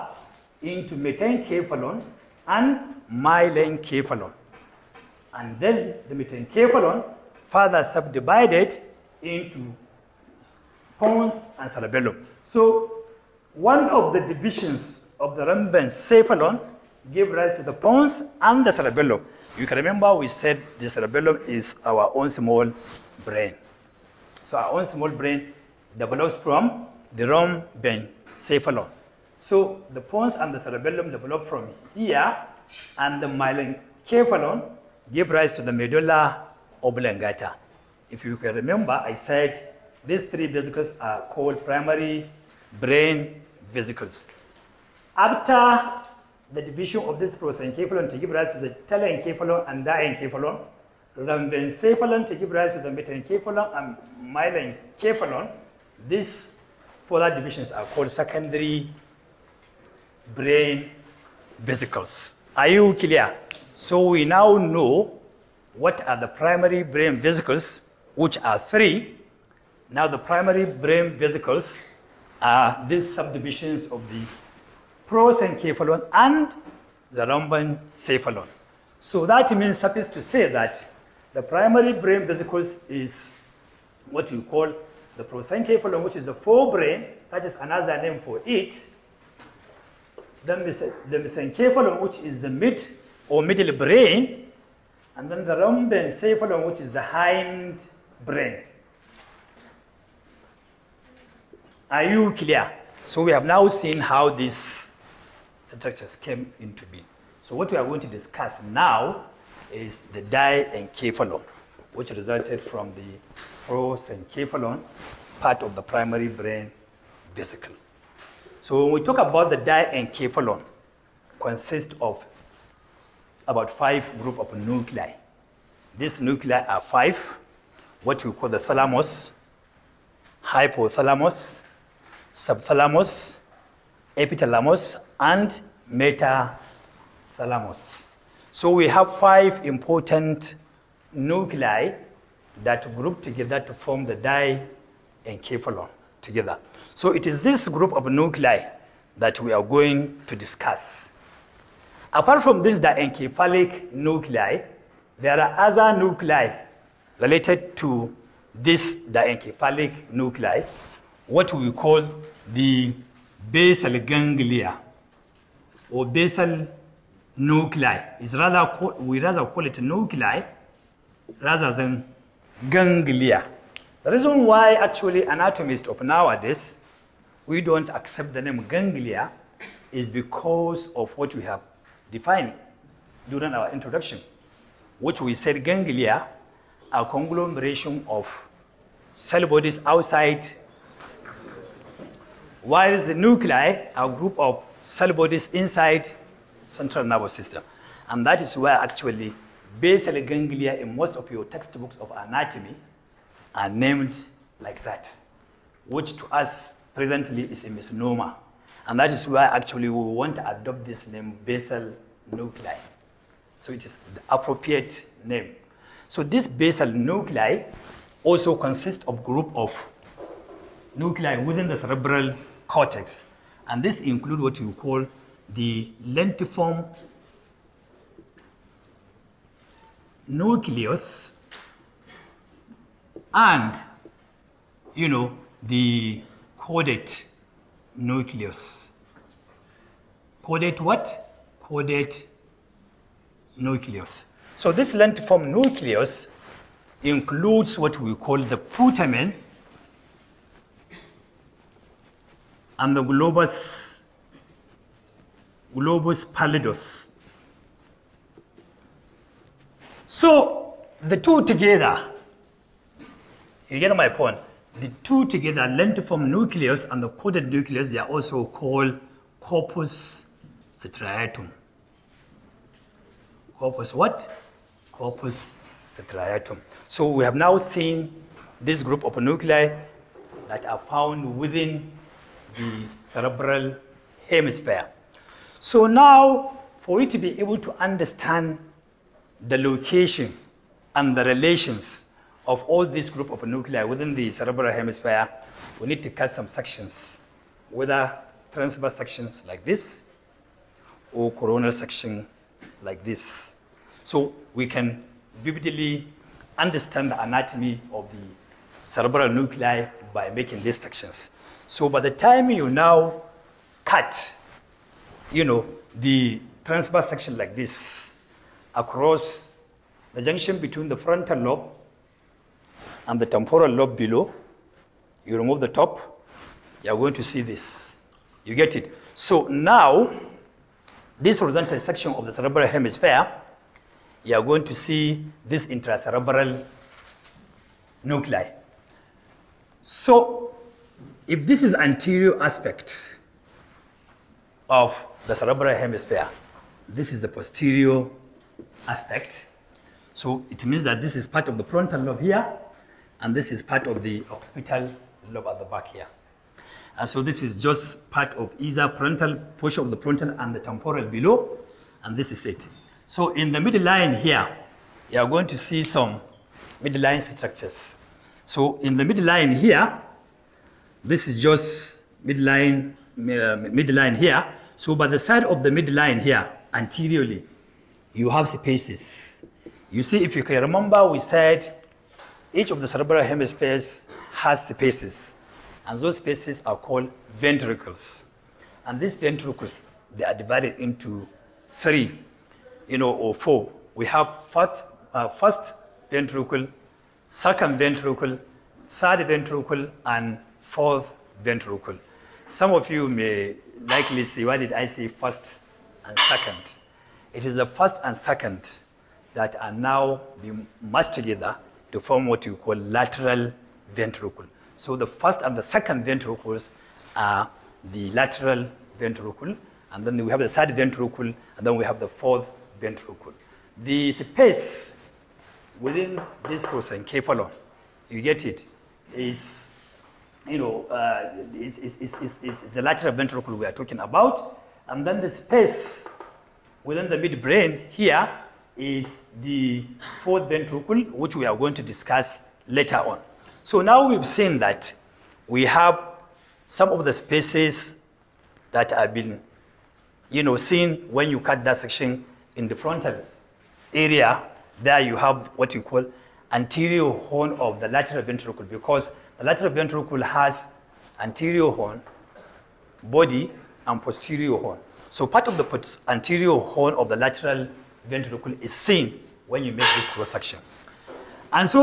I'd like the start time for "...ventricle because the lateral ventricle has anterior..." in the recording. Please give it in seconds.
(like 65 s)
458 s.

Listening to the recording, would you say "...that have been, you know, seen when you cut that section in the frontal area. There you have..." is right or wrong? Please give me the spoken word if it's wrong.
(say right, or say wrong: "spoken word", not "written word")
right.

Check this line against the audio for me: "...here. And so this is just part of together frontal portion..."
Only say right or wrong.
wrong.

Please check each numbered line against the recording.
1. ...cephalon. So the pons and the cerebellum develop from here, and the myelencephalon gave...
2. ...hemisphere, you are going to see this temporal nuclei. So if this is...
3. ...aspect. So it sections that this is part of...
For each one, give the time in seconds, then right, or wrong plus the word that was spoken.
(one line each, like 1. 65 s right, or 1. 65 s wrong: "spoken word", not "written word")
1. 28 s right
2. 332 s wrong: "intracerebral", not "temporal"
3. 348 s wrong: "means", not "sections".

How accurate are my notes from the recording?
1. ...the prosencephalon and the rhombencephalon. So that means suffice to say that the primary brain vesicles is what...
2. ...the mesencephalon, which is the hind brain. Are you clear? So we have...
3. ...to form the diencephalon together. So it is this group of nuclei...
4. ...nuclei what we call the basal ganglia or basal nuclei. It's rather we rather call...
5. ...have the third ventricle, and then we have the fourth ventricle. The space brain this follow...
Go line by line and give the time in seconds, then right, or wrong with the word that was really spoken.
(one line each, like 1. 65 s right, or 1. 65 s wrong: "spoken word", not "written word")
1. 74 s right
2. 95 s wrong: "rhombencephalon", not "mesencephalon"
3. 143 s right
4. 160 s right
5. 420 s wrong: "within", not "brain".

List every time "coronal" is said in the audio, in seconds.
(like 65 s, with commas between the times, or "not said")
301 s.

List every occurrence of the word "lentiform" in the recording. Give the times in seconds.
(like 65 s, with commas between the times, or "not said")
226 s, 244 s, 265 s.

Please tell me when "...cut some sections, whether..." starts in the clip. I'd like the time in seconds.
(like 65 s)
296 s.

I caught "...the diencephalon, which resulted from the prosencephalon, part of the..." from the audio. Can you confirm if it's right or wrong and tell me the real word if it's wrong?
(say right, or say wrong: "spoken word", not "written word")
right.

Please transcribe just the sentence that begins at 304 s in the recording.
So we can vividly understand the anatomy of the cerebral nuclei by making these sections.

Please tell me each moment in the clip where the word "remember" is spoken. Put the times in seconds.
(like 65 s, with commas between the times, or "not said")
19 s, 38 s, 380 s.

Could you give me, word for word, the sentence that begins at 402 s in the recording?
Some of you may likely see, why did I say first and second?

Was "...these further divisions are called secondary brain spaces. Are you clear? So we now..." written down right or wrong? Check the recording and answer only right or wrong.
wrong.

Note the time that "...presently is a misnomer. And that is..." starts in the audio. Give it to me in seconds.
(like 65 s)
206 s.